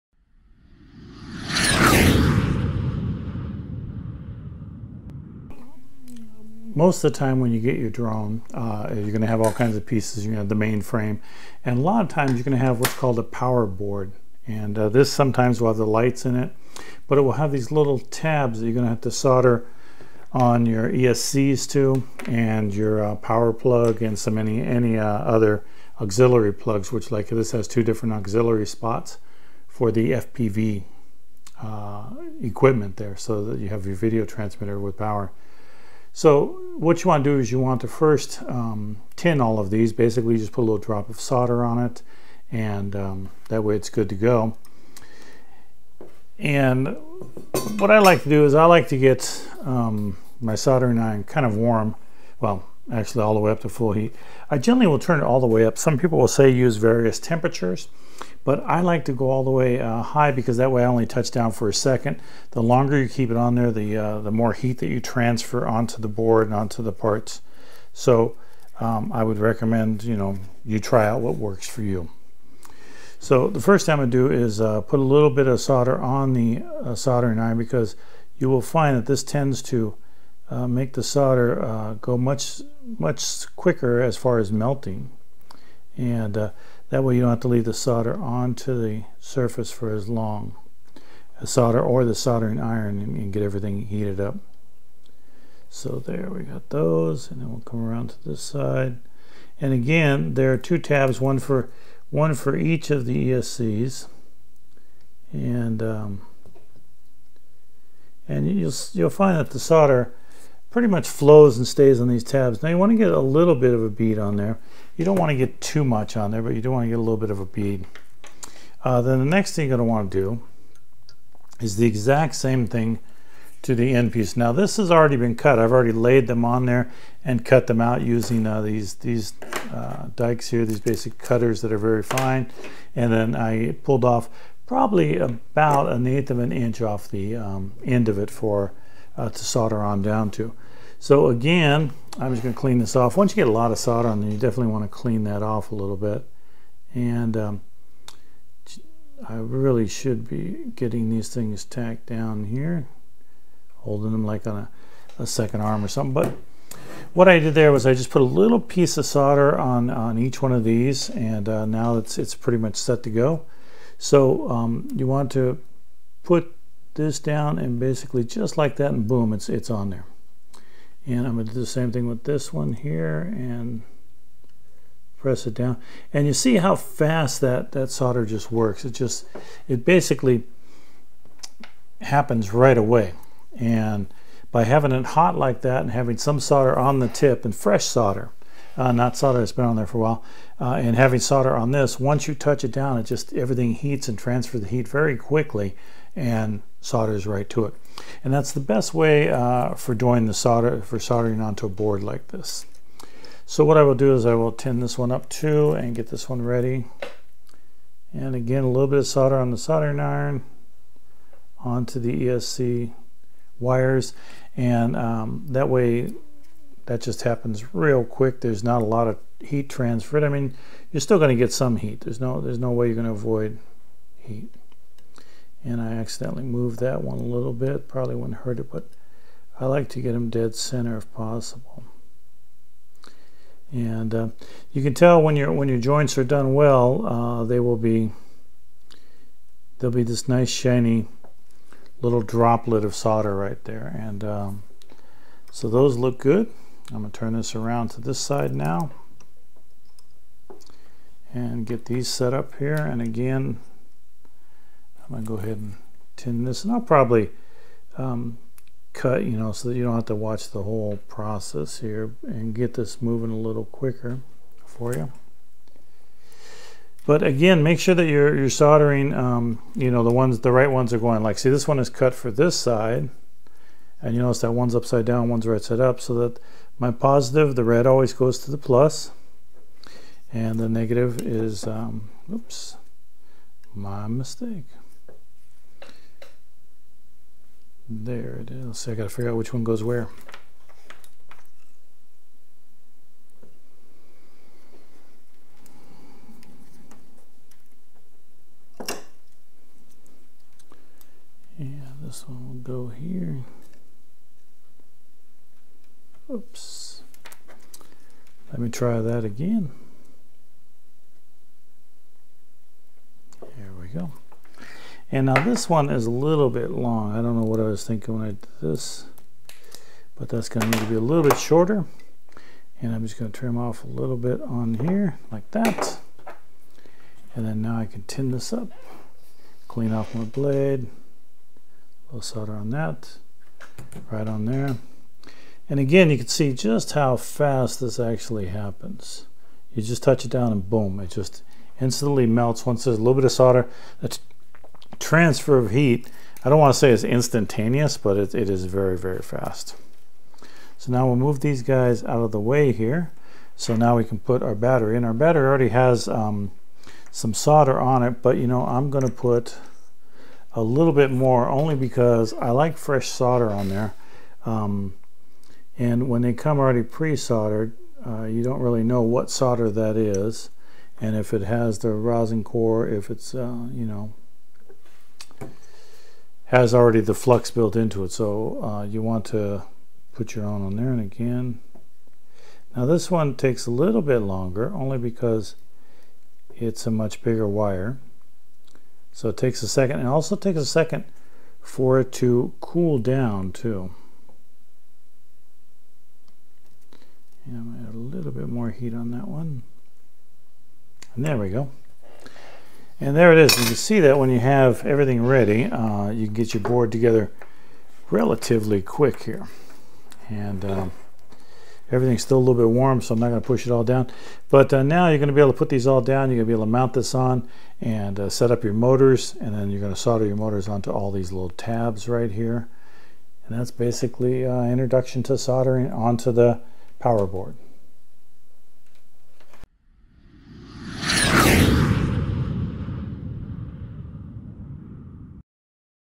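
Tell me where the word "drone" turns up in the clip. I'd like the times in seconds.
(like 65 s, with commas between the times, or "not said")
7 s.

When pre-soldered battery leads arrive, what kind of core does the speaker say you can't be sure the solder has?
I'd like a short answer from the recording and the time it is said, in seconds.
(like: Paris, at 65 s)
rosin core, at 371 s.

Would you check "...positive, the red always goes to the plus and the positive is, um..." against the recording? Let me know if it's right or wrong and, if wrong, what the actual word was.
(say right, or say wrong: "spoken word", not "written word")
wrong: "negative", not "positive".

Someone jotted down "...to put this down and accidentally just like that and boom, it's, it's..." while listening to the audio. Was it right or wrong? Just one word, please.
wrong.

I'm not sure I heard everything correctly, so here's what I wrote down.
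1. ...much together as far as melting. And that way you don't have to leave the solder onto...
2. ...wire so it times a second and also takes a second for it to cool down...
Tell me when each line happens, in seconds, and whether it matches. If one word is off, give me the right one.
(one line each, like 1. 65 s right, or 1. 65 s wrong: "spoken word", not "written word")
1. 82 s wrong: "quicker", not "together"
2. 387 s wrong: "takes", not "times".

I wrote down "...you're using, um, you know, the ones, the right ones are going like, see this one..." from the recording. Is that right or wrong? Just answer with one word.
wrong.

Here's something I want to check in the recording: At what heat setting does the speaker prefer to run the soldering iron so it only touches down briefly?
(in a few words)
full heat.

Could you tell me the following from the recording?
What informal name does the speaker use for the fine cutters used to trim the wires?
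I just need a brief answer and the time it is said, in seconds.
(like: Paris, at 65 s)
dikes, at 130 s.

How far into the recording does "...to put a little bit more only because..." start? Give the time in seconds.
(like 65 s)
359 s.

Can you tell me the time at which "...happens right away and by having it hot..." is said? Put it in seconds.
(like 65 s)
182 s.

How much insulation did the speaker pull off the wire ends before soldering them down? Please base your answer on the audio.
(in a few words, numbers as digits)
an eighth of an inch.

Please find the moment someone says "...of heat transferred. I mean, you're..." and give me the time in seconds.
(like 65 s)
219 s.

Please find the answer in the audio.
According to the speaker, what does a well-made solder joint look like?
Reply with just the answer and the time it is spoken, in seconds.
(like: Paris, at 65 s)
shiny little droplet, at 240 s.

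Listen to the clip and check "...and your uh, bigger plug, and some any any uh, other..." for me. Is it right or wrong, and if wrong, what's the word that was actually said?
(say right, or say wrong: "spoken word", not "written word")
wrong: "power", not "bigger".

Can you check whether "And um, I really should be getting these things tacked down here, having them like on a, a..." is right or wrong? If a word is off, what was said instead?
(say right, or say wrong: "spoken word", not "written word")
wrong: "holding", not "having".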